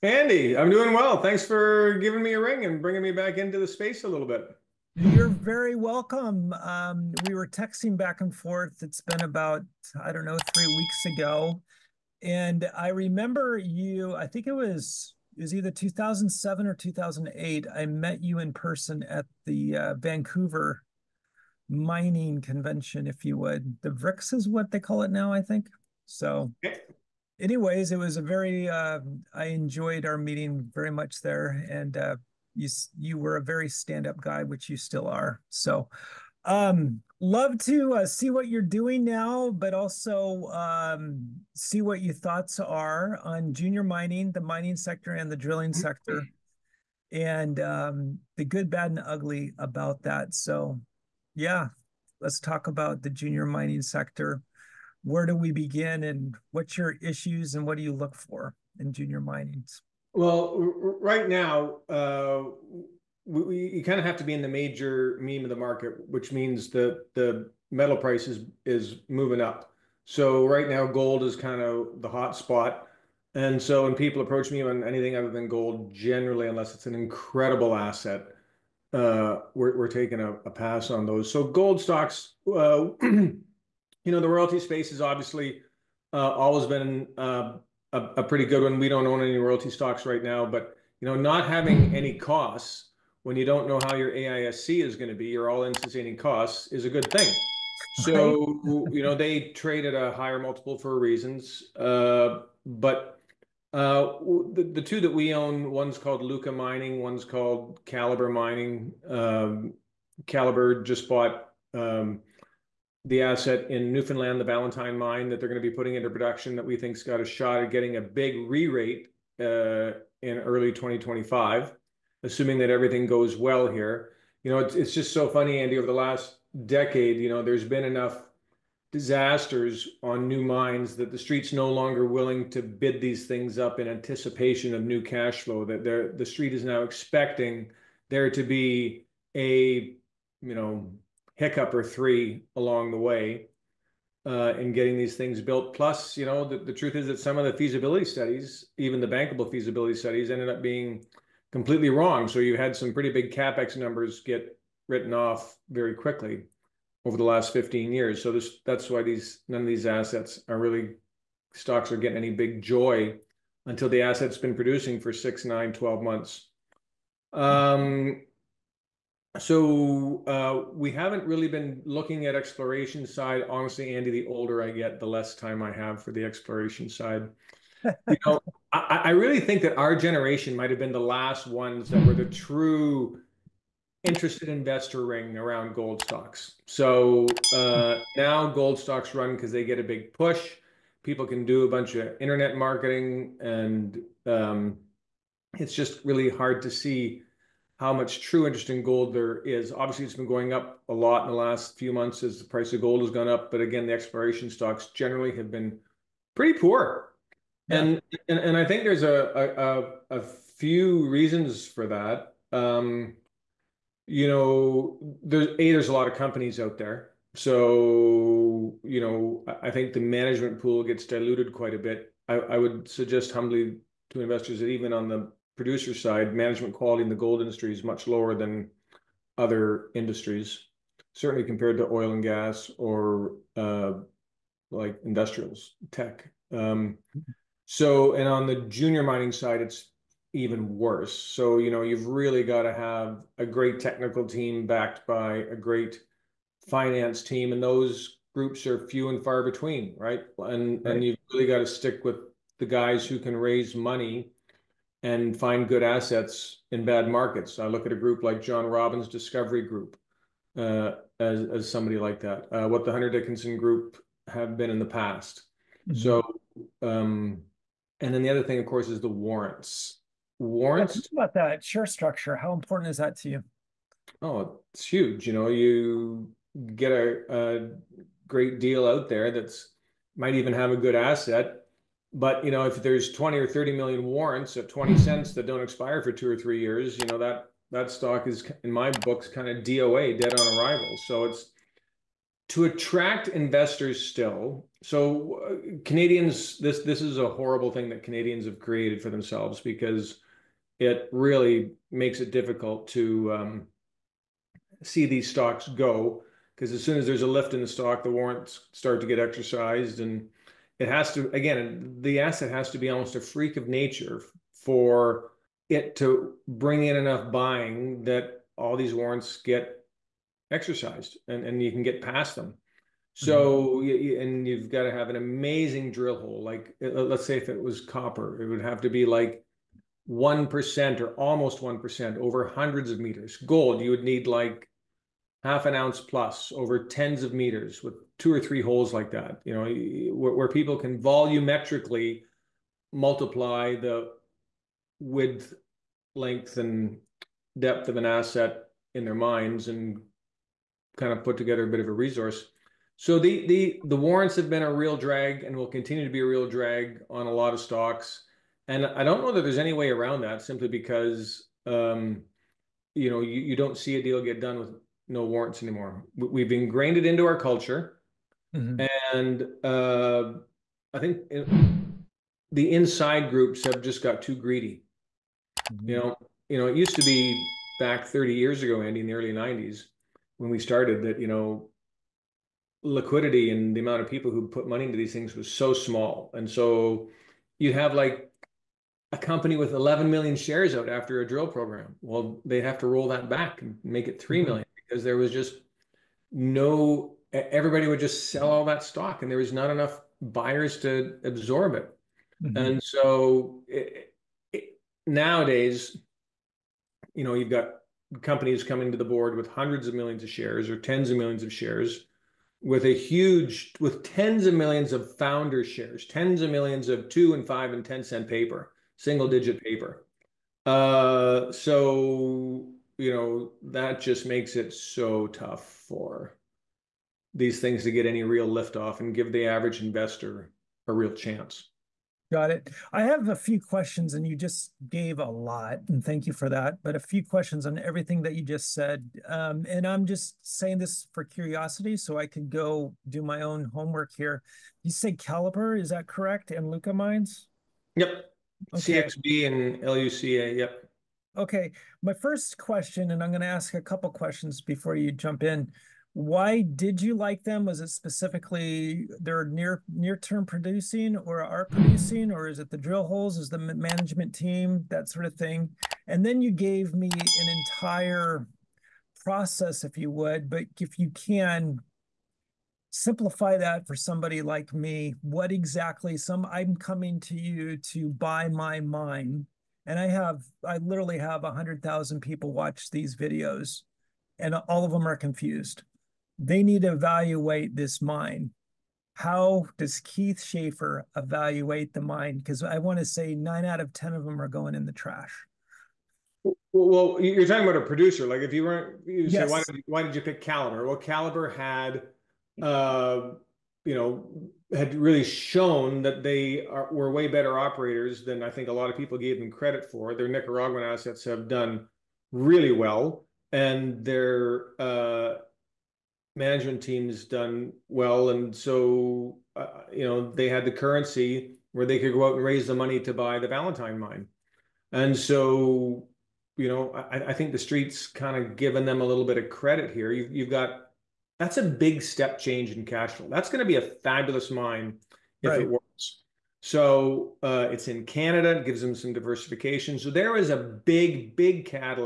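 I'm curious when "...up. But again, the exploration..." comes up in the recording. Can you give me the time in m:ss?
3:23.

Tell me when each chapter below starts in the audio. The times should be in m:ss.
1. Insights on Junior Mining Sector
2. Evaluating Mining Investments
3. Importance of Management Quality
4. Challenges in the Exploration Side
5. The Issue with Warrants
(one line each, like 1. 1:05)
1. 0:50
2. 7:11
3. 3:41
4. 2:46
5. 4:25.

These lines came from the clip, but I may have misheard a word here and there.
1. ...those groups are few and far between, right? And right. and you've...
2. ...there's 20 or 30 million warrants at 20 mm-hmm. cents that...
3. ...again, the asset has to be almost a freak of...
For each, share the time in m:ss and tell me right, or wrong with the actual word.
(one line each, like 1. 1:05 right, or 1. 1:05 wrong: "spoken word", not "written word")
1. 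4:07 right
2. 4:42 right
3. 5:11 right.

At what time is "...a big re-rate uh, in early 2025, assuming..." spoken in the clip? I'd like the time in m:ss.
1:57.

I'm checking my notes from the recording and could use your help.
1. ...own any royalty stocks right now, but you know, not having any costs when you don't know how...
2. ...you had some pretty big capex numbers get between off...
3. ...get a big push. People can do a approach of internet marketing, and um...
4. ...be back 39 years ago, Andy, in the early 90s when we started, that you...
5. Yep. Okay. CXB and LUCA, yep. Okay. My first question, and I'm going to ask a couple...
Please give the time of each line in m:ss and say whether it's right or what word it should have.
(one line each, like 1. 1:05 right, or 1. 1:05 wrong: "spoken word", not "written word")
1. 1:29 right
2. 2:32 wrong: "written", not "between"
3. 3:09 wrong: "bunch", not "approach"
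4. 6:17 wrong: "30", not "39"
5. 7:27 right.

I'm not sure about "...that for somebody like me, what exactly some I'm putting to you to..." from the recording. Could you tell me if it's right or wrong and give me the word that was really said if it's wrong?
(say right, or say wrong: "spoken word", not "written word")
wrong: "coming", not "putting".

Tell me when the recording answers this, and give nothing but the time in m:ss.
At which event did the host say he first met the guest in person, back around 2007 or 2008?
0:19.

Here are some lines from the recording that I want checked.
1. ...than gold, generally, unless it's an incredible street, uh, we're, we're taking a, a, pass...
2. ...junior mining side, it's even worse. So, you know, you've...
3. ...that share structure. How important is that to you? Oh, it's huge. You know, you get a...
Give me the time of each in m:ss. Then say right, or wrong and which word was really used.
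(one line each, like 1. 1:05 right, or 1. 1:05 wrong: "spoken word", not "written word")
1. 1:15 wrong: "asset", not "street"
2. 3:58 right
3. 4:31 right.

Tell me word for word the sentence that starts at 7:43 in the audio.
Is the management team that sort of thing?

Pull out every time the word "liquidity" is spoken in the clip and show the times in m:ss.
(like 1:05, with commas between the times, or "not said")
6:22.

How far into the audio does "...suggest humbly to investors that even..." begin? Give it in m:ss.
3:42.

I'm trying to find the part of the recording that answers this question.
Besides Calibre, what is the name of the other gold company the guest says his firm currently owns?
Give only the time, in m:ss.
1:46.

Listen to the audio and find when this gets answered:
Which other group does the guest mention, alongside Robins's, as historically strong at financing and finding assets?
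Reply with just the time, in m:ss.
4:22.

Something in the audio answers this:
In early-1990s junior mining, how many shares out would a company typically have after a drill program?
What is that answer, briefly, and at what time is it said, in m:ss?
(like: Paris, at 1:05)
11 million, at 6:29.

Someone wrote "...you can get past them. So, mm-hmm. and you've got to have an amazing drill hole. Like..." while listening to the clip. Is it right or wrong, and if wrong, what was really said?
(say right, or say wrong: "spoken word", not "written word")
right.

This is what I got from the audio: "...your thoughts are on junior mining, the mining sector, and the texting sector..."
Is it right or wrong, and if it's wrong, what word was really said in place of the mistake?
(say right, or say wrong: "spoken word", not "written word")
wrong: "drilling", not "texting".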